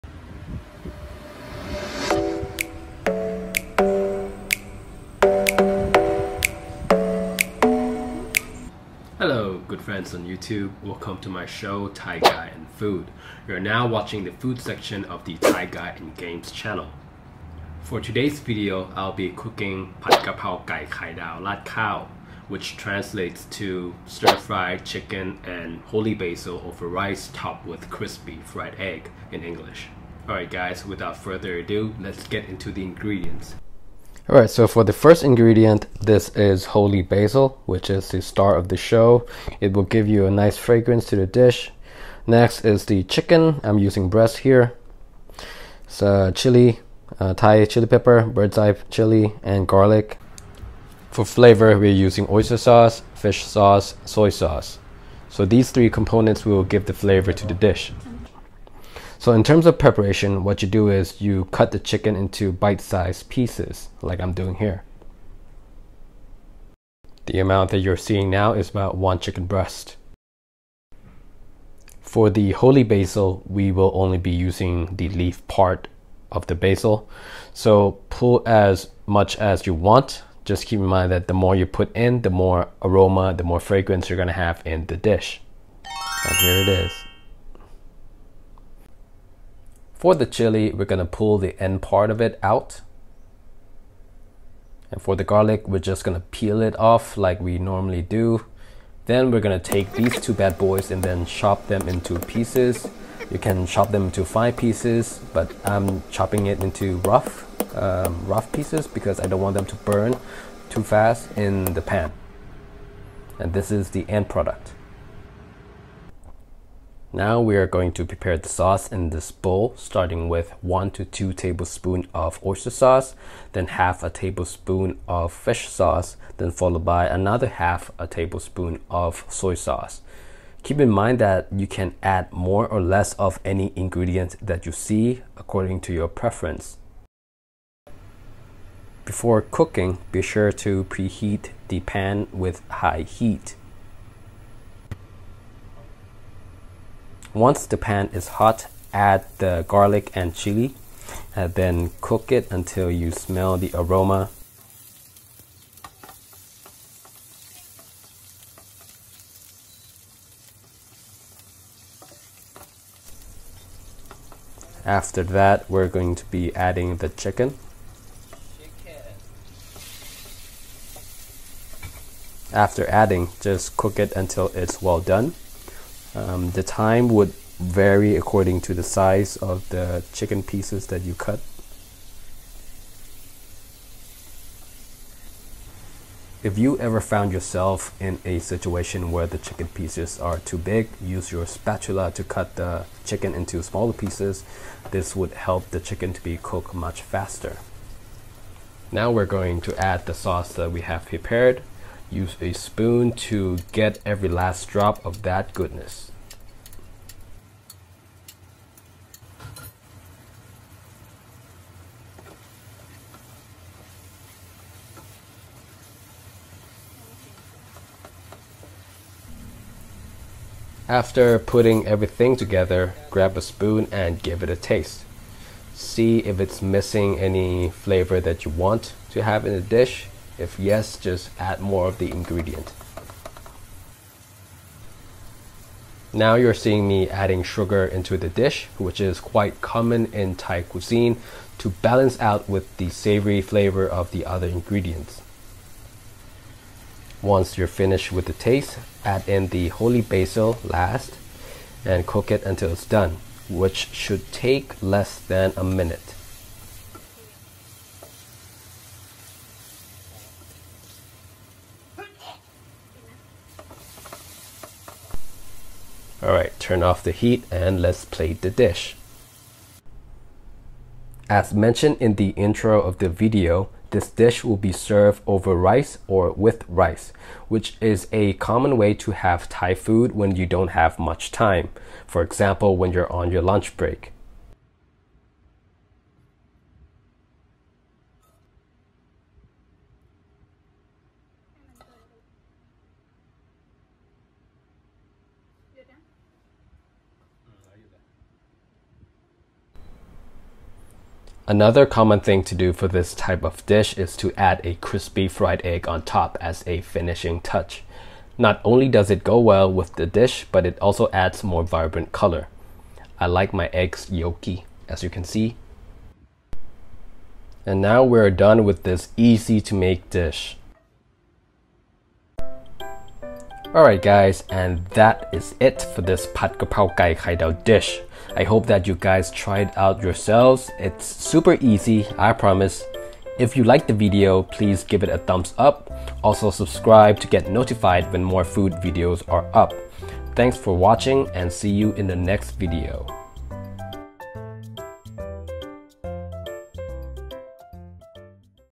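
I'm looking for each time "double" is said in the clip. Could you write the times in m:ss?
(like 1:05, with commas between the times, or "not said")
not said.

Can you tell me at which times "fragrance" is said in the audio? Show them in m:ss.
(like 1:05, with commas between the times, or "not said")
0:40, 1:23.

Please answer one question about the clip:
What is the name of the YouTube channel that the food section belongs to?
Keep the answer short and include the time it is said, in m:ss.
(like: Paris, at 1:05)
Thai Guy and Games, at 0:15.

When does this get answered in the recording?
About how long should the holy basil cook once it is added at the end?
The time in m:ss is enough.
4:14.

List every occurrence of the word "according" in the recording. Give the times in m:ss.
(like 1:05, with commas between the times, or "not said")
2:15, 2:58.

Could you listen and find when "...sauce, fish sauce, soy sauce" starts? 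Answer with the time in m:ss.
0:52.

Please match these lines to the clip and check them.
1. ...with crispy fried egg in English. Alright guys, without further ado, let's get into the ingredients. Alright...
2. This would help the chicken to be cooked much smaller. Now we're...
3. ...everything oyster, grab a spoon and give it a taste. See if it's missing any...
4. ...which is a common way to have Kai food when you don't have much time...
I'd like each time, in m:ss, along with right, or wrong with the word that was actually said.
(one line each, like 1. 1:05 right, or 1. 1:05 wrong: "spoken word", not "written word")
1. 0:27 right
2. 3:14 wrong: "faster", not "smaller"
3. 3:41 wrong: "together", not "oyster"
4. 4:37 wrong: "Thai", not "Kai".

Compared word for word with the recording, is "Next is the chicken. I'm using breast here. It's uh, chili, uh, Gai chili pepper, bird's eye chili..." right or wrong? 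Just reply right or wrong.
wrong.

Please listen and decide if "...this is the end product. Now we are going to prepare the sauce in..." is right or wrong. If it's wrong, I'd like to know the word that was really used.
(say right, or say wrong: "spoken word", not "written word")
right.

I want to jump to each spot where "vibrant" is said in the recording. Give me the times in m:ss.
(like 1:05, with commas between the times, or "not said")
5:11.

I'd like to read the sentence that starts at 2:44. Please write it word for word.
After that, we're going to be adding the chicken.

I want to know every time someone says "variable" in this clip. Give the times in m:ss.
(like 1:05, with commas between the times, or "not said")
not said.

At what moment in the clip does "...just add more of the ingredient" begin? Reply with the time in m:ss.
3:50.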